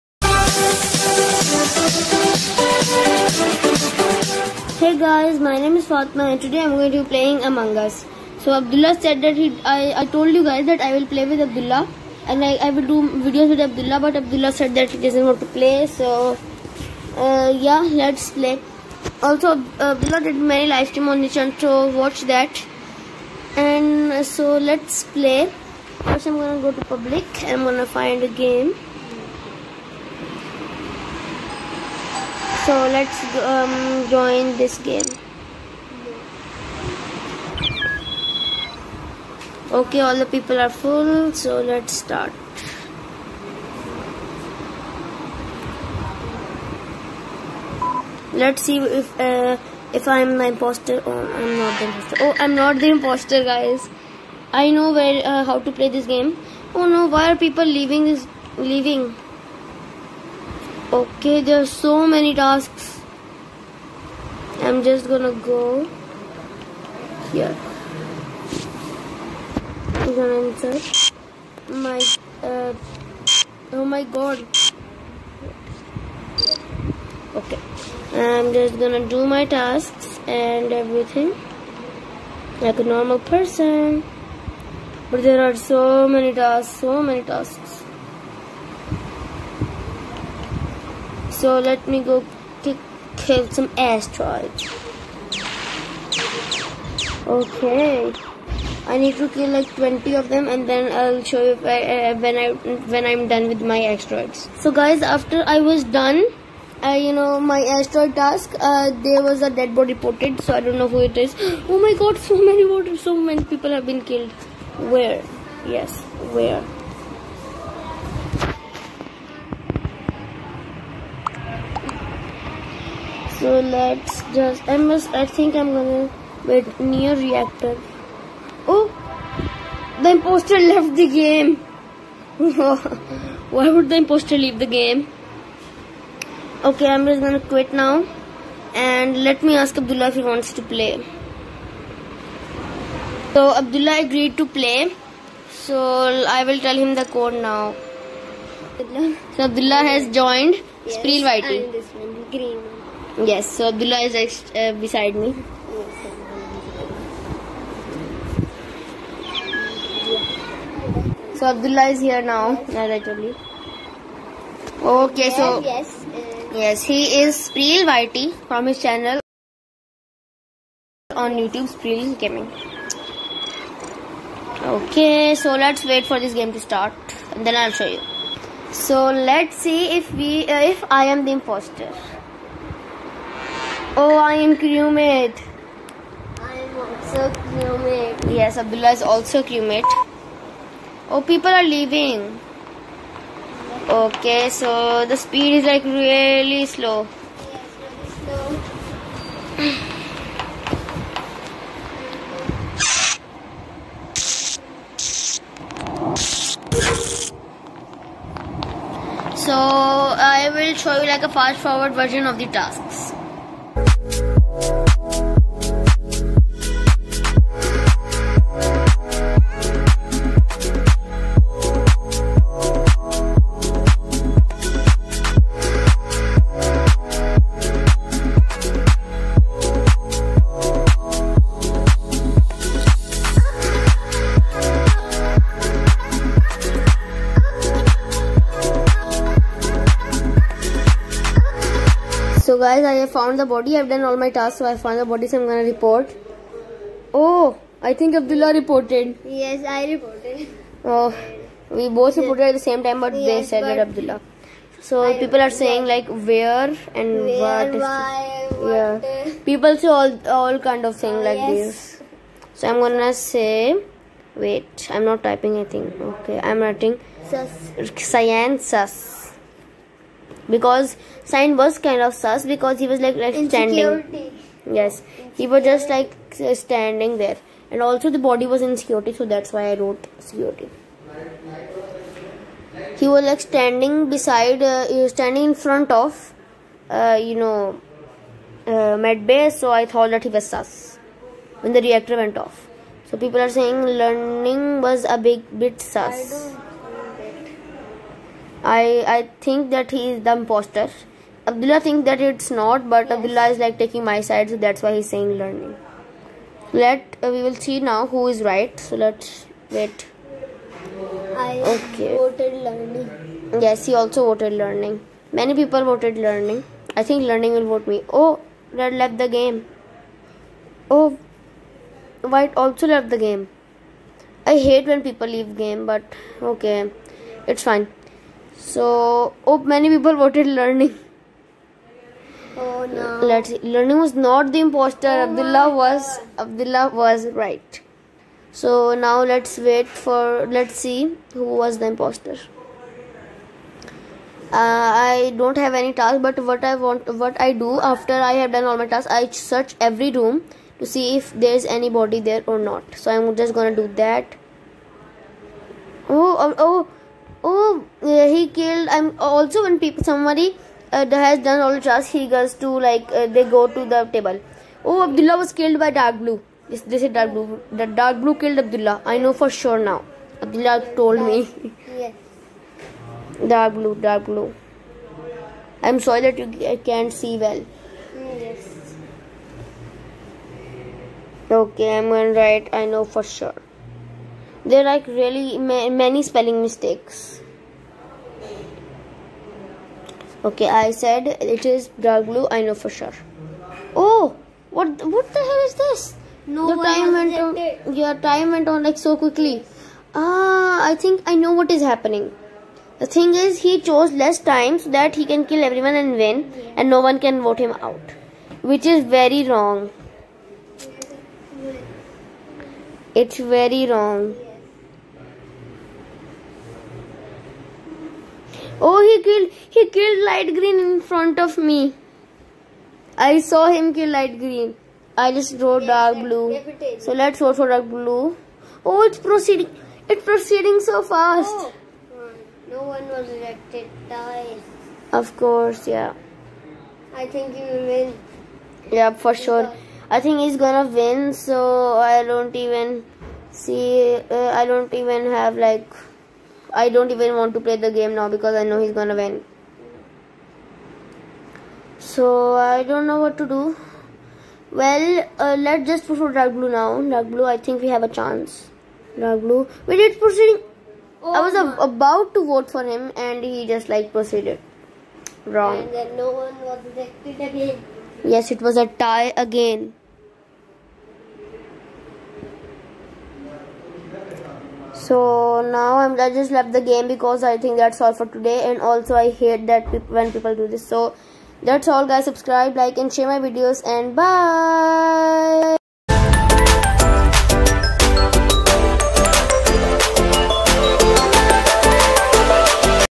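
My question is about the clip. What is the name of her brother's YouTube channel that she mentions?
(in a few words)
Spreel Gaming.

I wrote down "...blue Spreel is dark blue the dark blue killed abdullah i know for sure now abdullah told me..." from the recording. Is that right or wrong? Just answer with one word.
wrong.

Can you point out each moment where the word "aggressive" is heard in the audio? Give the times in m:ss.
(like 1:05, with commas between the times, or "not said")
not said.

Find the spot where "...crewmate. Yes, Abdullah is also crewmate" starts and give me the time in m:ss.
3:07.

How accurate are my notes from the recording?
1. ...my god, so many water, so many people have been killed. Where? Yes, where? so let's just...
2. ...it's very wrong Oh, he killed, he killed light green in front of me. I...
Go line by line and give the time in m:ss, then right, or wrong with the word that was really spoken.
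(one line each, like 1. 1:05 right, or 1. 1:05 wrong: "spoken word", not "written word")
1. 1:51 right
2. 6:53 right.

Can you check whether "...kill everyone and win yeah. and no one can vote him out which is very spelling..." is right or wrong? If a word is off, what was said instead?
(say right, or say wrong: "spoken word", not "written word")
wrong: "wrong", not "spelling".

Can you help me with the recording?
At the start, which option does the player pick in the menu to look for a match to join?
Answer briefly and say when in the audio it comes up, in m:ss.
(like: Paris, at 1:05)
Public, at 0:26.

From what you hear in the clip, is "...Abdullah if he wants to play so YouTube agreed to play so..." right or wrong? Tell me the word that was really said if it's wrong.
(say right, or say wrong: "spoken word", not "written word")
wrong: "Abdullah", not "YouTube".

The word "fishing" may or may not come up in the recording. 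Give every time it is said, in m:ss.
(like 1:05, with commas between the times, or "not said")
not said.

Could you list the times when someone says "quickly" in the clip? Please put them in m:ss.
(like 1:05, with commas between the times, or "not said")
6:39.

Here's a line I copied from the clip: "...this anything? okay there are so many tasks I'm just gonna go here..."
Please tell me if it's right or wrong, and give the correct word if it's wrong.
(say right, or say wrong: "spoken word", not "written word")
wrong: "leaving", not "anything".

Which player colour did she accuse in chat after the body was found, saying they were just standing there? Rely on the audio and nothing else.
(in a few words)
Science.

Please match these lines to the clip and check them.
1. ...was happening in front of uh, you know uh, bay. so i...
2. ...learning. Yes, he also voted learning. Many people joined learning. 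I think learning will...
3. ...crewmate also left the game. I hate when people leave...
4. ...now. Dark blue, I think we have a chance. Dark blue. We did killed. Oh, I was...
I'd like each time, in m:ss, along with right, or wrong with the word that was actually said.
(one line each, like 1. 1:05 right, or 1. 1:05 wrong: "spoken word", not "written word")
1. 4:45 wrong: "standing", not "happening"
2. 5:12 wrong: "voted", not "joined"
3. 5:22 wrong: "white", not "crewmate"
4. 7:36 wrong: "proceed", not "killed".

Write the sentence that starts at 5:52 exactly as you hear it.
So I'm just gonna do that.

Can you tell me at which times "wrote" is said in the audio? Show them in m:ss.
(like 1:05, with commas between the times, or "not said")
4:39.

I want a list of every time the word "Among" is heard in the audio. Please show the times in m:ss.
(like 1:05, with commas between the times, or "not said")
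0:07.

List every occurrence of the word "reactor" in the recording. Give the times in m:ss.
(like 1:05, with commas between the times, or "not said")
2:07, 4:51.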